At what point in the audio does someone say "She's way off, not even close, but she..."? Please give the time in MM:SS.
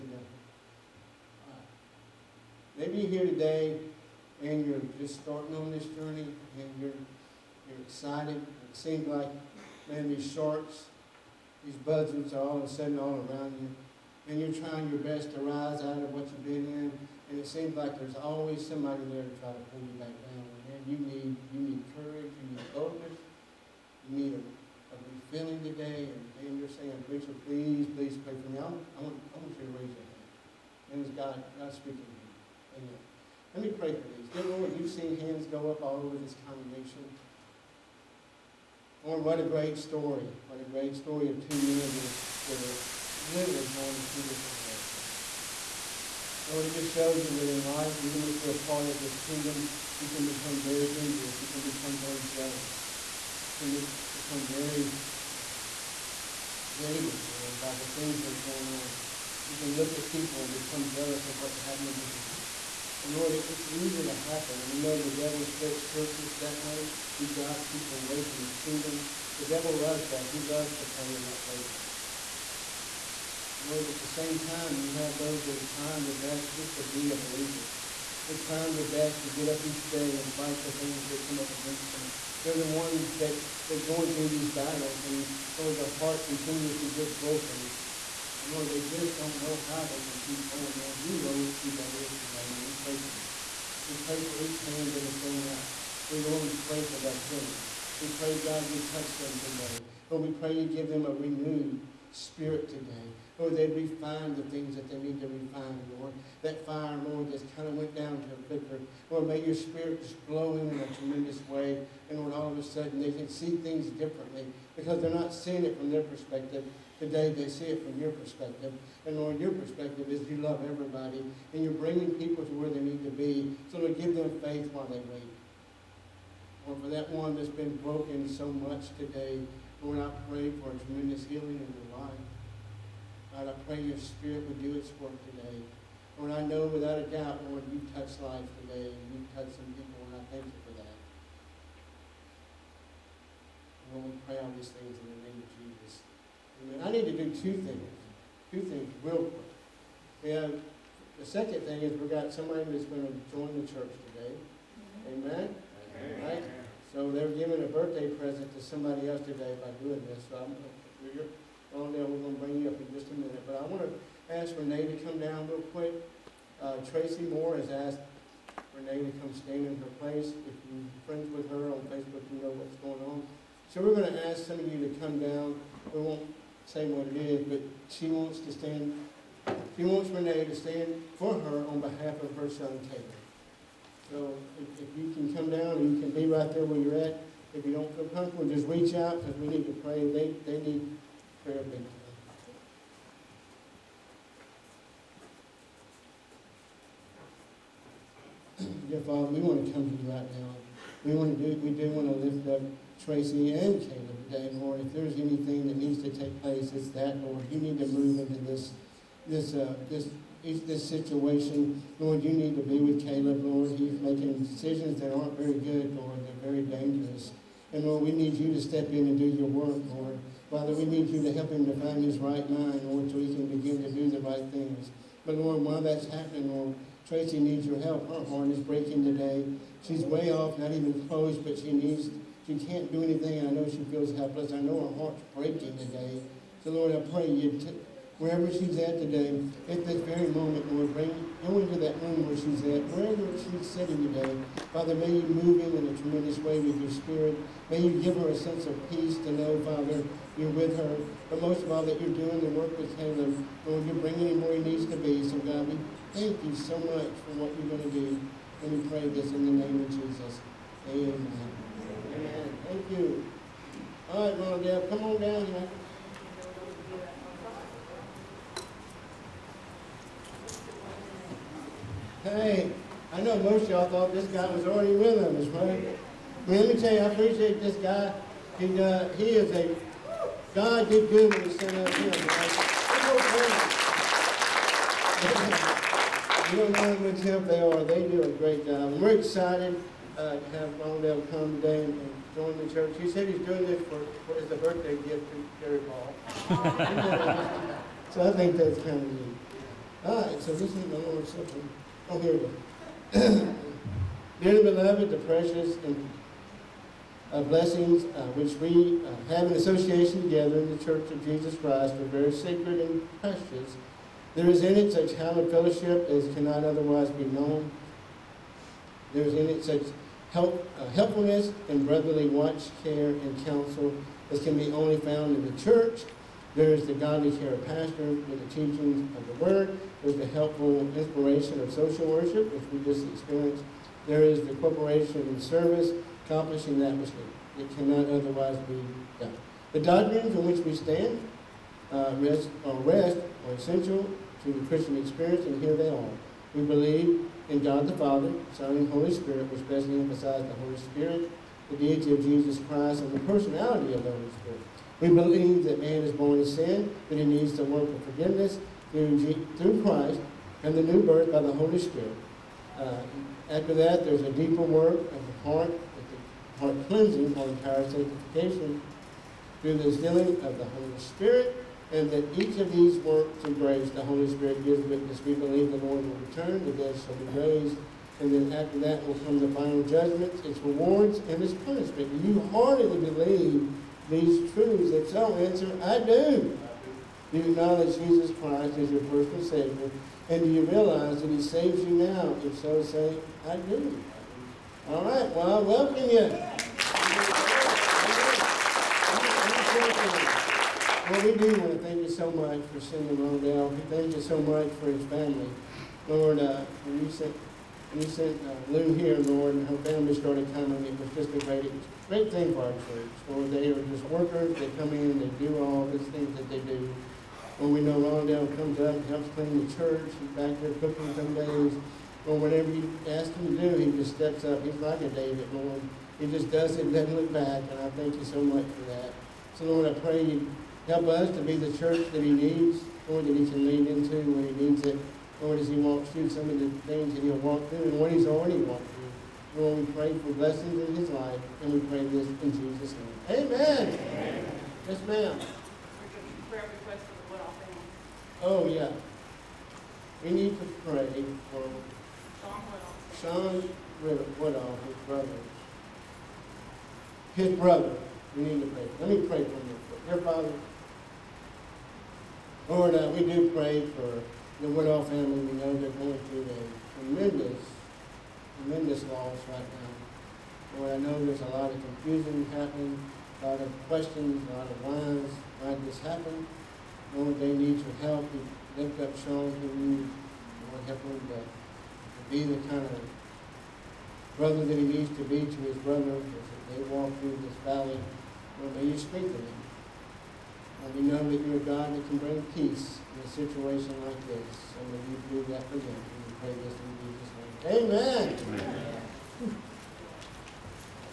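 03:49.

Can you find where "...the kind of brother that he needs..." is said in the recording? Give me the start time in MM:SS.
08:02.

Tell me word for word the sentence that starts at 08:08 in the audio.
Lord, may you speak to them.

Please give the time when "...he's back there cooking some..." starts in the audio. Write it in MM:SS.
07:00.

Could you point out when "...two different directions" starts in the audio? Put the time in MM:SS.
00:44.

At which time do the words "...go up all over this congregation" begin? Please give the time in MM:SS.
00:35.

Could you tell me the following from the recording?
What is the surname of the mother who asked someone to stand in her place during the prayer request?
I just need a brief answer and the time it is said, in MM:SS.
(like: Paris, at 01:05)
Moore, at 02:47.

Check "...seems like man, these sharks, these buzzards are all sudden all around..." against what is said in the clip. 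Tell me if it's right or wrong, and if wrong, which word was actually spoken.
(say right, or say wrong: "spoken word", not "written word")
right.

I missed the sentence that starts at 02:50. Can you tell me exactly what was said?
If you're friends with her on Facebook, you know what's going on.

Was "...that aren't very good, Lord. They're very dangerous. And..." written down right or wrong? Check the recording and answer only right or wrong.
right.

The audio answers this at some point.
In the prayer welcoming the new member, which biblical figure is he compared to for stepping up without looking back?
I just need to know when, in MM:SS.
07:05.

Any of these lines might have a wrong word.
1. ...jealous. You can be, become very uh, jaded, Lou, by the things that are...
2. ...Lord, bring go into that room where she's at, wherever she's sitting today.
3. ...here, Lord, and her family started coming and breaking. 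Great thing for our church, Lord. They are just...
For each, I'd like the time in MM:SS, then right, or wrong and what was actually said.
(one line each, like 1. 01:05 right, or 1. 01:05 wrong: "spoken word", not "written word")
1. 00:52 wrong: "Lord", not "Lou"
2. 04:00 right
3. 06:48 wrong: "participating", not "breaking".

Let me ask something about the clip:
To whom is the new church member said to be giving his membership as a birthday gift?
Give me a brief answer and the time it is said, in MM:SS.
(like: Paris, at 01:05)
Gary Ball, at 04:55.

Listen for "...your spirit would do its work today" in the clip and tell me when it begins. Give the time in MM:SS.
02:13.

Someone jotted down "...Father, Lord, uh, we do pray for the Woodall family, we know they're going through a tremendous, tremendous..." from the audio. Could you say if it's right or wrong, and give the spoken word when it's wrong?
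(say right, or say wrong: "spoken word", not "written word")
right.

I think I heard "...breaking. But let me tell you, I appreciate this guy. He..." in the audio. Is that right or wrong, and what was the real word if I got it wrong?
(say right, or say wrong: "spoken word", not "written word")
wrong: "morning", not "breaking".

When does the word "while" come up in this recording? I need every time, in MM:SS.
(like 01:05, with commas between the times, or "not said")
02:04, 03:45.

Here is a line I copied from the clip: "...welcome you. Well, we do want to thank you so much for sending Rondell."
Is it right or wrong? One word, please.
right.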